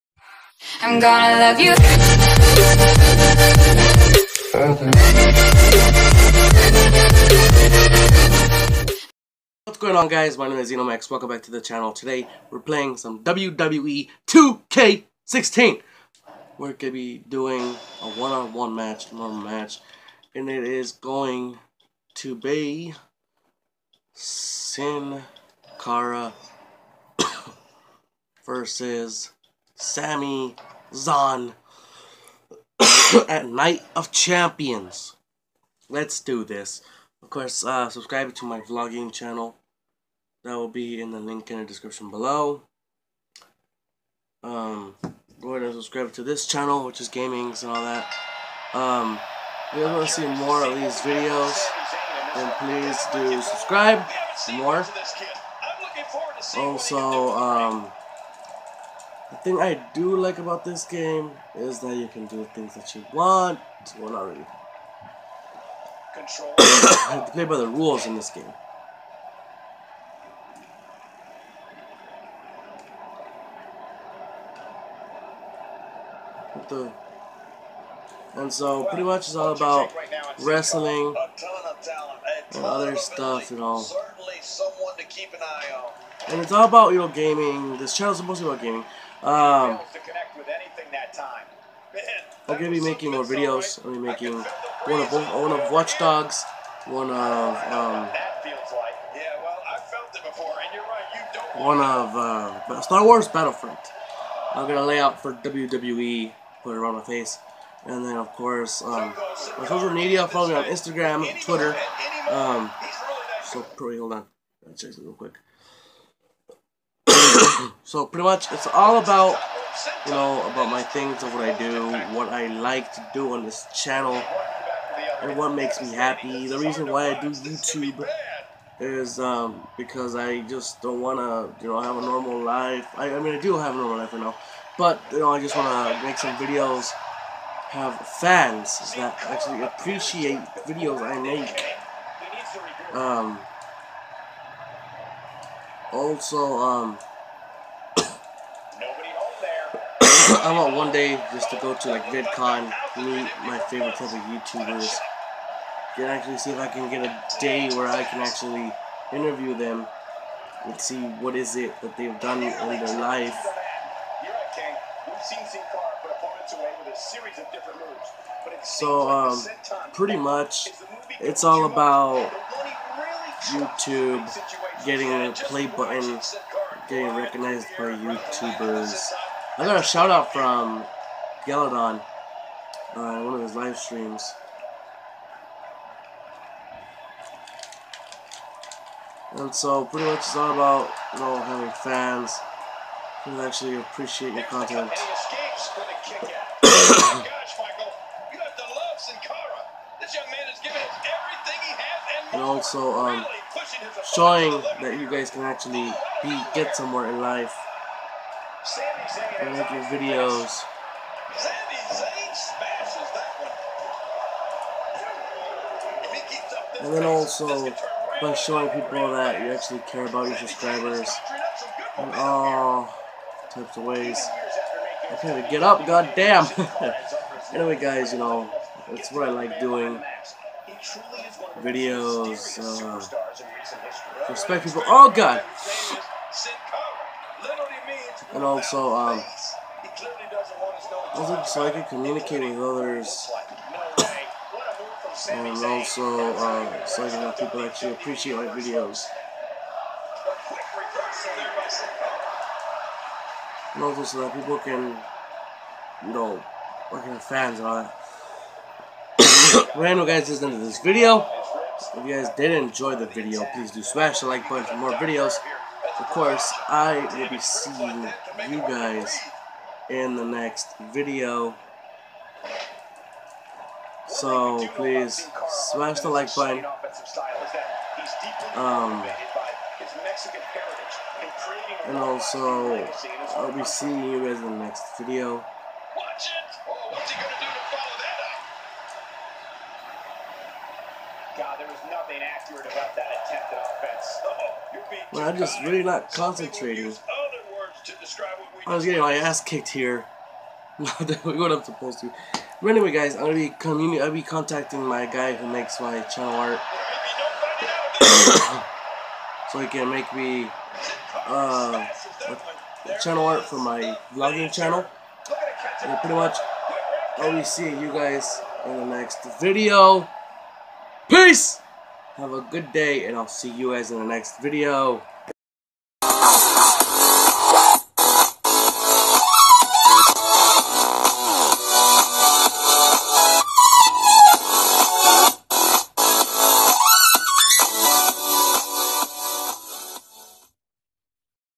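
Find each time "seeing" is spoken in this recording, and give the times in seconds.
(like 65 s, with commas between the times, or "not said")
267 s, 283 s, 317 s.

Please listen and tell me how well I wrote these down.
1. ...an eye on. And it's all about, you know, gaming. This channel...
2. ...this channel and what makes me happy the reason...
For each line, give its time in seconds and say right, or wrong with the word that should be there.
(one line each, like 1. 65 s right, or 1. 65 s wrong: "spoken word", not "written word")
1. 85 s right
2. 123 s right.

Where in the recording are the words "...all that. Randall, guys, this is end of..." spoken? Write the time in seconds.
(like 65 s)
257 s.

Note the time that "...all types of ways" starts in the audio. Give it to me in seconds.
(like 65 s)
222 s.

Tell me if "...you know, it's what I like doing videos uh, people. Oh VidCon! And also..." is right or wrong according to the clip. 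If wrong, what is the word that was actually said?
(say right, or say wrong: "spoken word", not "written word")
wrong: "God", not "VidCon".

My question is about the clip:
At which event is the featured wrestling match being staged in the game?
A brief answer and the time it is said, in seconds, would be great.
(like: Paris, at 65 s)
Night of Champions, at 33 s.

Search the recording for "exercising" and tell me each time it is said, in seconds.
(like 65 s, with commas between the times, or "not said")
not said.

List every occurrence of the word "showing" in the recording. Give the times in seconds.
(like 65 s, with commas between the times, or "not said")
204 s, 218 s.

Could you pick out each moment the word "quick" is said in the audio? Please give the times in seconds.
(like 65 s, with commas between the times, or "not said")
115 s.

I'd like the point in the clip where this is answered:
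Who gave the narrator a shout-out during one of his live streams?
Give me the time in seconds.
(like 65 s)
181 s.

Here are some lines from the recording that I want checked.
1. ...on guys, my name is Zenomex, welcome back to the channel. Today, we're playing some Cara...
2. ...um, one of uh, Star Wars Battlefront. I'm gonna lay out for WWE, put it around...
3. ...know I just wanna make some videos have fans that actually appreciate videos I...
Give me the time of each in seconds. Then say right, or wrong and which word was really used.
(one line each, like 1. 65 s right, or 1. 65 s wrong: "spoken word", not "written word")
1. 9 s wrong: "WWE", not "Cara"
2. 97 s right
3. 135 s right.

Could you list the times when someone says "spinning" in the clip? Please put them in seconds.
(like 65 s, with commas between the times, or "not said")
not said.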